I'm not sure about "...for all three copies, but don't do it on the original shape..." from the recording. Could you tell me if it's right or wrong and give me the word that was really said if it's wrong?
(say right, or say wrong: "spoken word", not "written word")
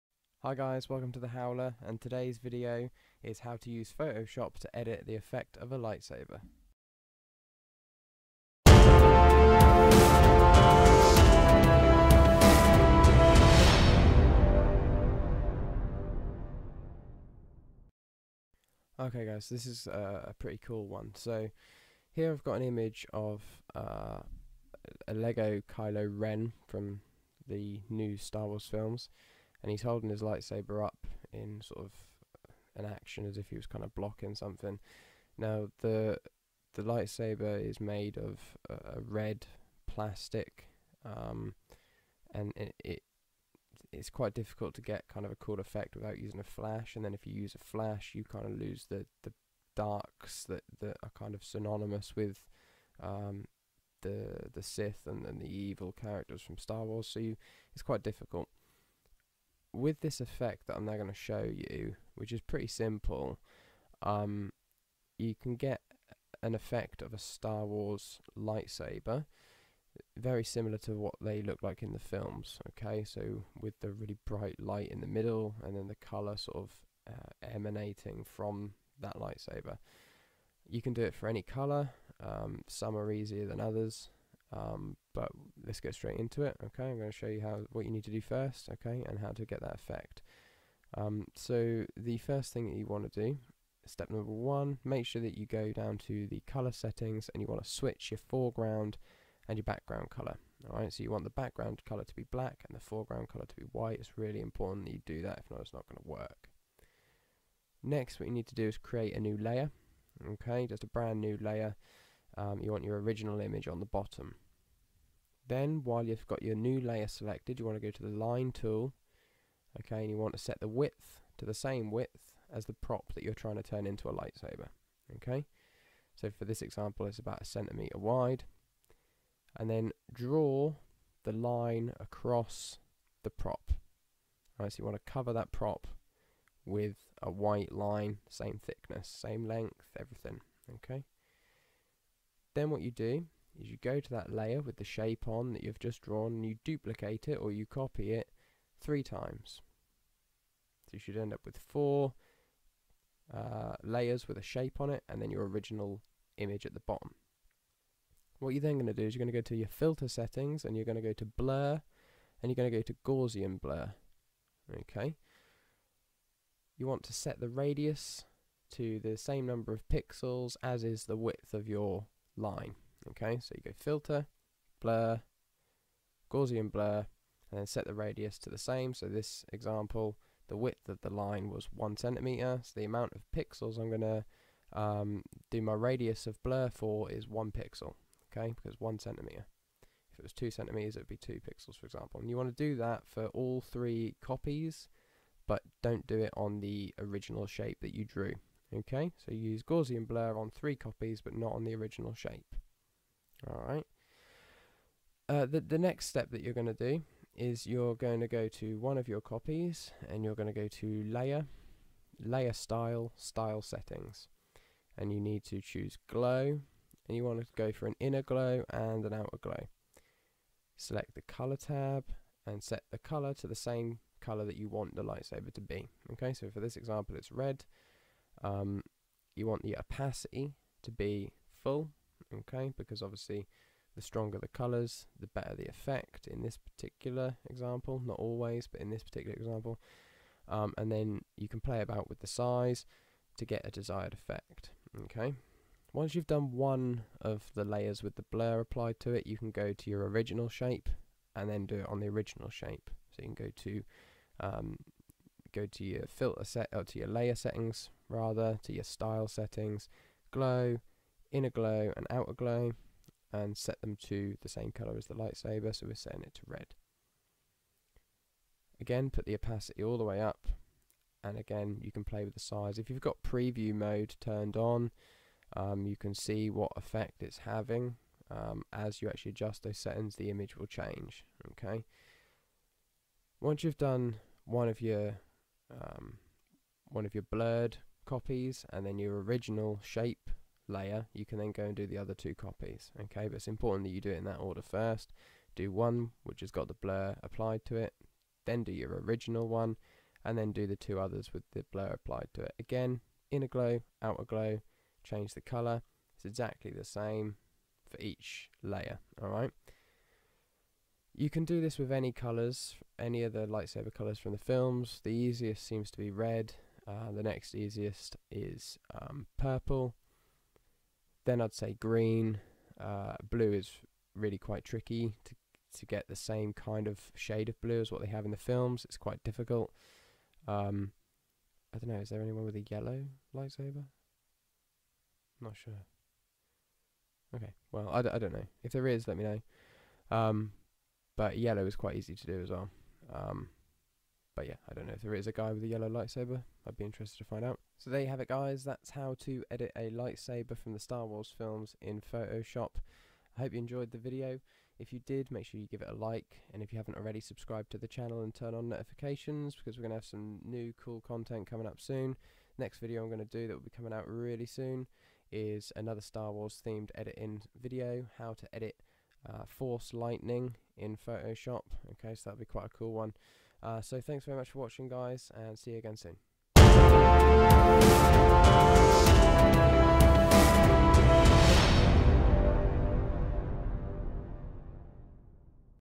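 right.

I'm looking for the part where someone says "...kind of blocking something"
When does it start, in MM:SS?
00:33.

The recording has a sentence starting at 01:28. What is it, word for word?
Okay, and how to get that effect.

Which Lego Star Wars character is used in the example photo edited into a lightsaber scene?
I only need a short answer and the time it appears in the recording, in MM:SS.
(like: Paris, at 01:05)
Kylo Ren, at 00:25.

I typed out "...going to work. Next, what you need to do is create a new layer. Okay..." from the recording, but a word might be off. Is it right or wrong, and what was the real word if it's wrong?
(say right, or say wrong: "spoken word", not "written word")
right.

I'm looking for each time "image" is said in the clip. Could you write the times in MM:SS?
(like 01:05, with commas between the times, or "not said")
00:22, 01:53, 02:36, 04:40.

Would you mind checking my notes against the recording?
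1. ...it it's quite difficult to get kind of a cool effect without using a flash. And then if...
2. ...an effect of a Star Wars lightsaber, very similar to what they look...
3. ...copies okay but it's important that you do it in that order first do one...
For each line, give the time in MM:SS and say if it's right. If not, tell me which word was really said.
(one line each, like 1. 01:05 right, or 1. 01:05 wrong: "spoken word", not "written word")
1. 00:42 right
2. 01:06 right
3. 04:52 right.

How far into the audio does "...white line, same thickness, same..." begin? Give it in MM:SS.
02:17.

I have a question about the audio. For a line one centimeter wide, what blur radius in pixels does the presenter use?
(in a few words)
1 pixel.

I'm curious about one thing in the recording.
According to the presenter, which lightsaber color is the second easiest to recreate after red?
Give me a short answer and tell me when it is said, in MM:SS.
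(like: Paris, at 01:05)
purple, at 05:19.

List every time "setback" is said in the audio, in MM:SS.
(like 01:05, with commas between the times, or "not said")
not said.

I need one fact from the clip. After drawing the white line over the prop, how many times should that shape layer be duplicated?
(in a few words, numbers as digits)
3.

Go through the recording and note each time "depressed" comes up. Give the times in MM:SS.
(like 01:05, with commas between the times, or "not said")
not said.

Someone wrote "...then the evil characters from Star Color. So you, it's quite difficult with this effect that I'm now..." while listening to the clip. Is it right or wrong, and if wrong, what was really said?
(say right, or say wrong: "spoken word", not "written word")
wrong: "Wars", not "Color".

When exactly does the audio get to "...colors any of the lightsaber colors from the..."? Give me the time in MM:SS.
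05:12.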